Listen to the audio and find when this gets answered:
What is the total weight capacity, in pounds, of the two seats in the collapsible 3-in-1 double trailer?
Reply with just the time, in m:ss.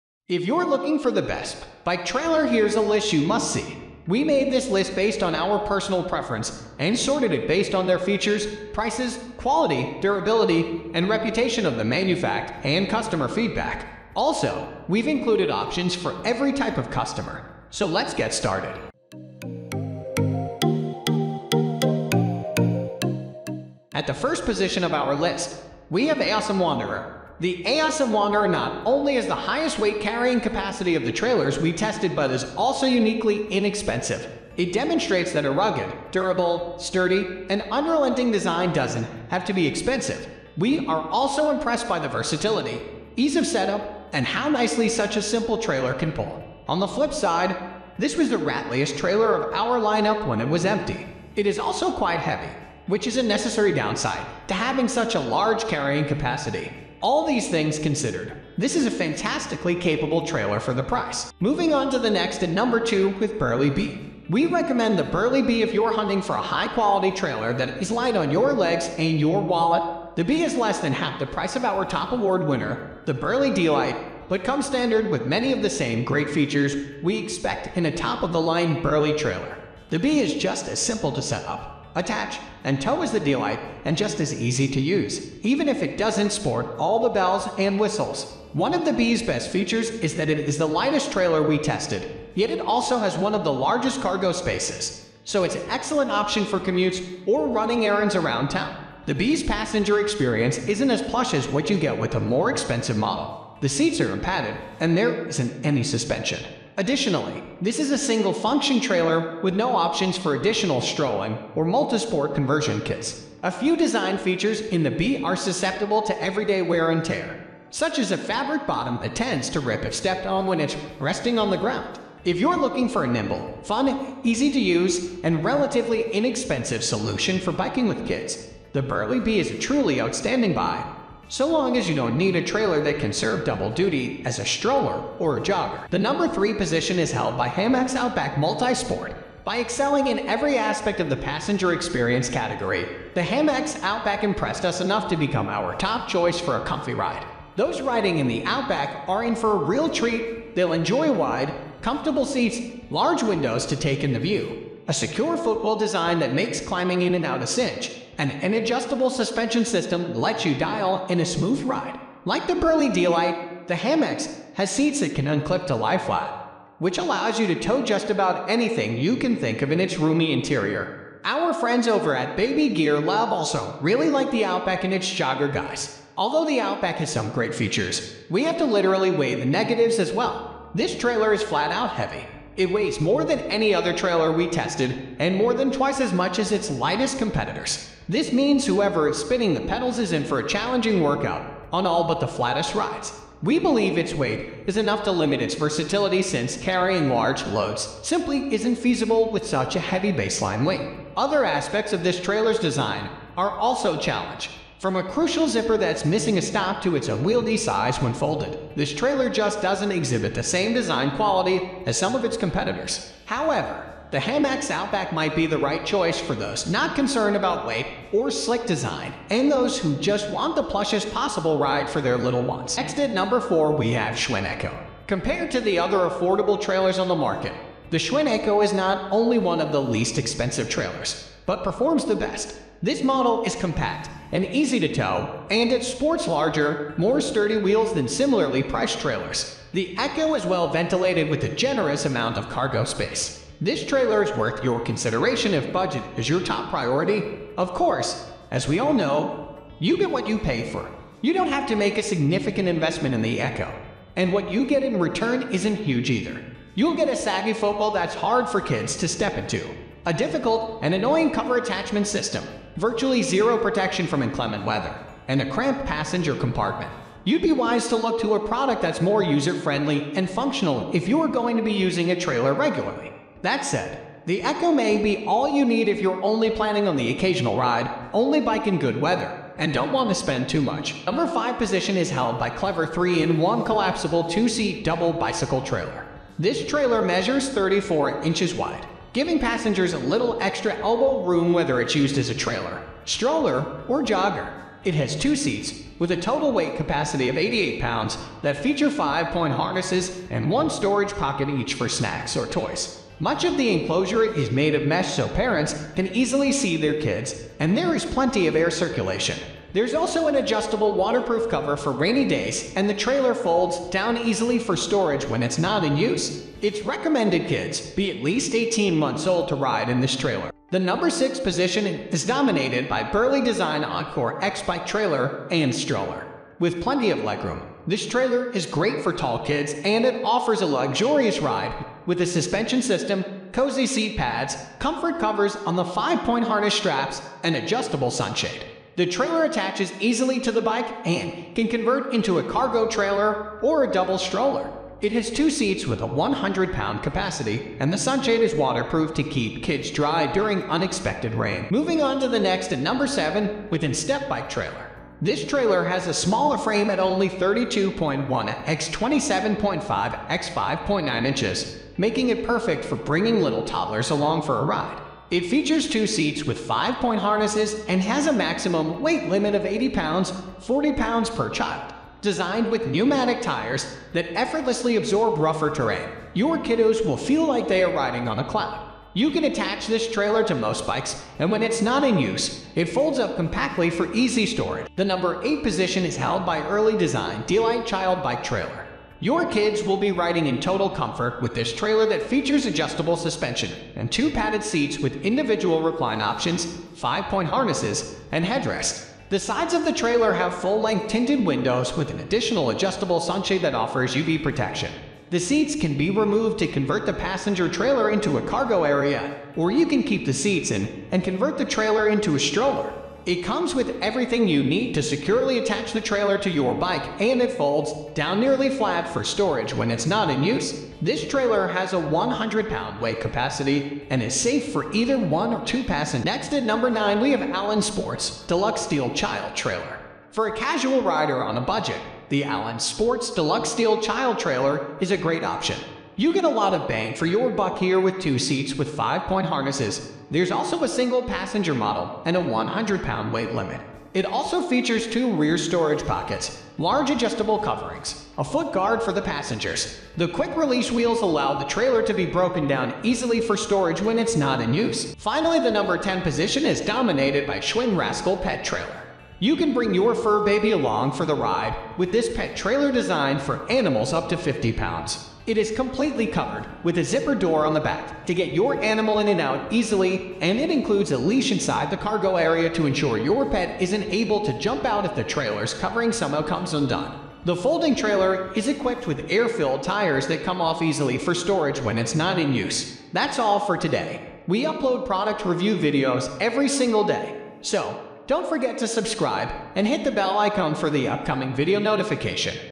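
4:57.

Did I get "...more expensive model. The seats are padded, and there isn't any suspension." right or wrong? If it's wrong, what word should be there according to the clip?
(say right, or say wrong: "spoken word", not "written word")
right.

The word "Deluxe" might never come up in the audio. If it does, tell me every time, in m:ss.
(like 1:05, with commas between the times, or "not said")
7:08, 7:13.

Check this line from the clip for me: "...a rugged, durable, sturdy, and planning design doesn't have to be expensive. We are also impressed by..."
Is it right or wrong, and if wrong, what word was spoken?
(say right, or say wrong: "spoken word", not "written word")
wrong: "unrelenting", not "planning".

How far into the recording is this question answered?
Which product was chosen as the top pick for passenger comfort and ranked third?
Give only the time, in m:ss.
2:17.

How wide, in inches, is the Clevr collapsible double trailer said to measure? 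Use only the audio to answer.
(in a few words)
34 inches.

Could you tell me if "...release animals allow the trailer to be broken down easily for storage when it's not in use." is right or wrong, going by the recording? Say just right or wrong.
wrong.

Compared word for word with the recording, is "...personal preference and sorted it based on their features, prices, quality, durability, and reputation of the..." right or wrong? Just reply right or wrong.
right.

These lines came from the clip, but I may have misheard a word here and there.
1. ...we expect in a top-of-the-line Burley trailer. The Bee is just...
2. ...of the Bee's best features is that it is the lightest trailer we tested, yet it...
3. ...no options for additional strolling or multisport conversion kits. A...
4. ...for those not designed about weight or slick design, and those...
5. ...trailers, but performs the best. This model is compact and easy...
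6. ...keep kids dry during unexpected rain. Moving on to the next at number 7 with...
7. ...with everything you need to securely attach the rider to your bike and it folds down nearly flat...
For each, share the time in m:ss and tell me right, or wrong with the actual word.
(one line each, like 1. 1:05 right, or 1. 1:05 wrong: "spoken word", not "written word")
1. 1:17 right
2. 1:28 right
3. 1:49 right
4. 3:36 wrong: "concerned", not "designed"
5. 3:50 right
6. 5:49 right
7. 6:53 wrong: "trailer", not "rider".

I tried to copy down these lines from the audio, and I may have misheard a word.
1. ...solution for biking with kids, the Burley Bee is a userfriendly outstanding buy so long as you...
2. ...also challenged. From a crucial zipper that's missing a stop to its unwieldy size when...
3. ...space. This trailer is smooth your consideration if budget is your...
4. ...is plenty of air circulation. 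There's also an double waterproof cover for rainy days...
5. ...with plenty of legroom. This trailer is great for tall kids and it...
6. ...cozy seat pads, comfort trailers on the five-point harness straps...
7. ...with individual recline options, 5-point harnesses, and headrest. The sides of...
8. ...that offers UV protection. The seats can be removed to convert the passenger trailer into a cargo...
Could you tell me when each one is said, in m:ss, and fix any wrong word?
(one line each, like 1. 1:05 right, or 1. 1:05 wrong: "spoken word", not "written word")
1. 2:06 wrong: "truly", not "userfriendly"
2. 3:23 right
3. 4:02 wrong: "worth", not "smooth"
4. 5:07 wrong: "adjustable", not "double"
5. 5:26 right
6. 5:33 wrong: "covers", not "trailers"
7. 6:34 right
8. 6:43 right.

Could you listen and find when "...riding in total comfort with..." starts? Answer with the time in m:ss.
6:30.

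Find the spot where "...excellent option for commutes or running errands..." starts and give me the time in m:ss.
1:35.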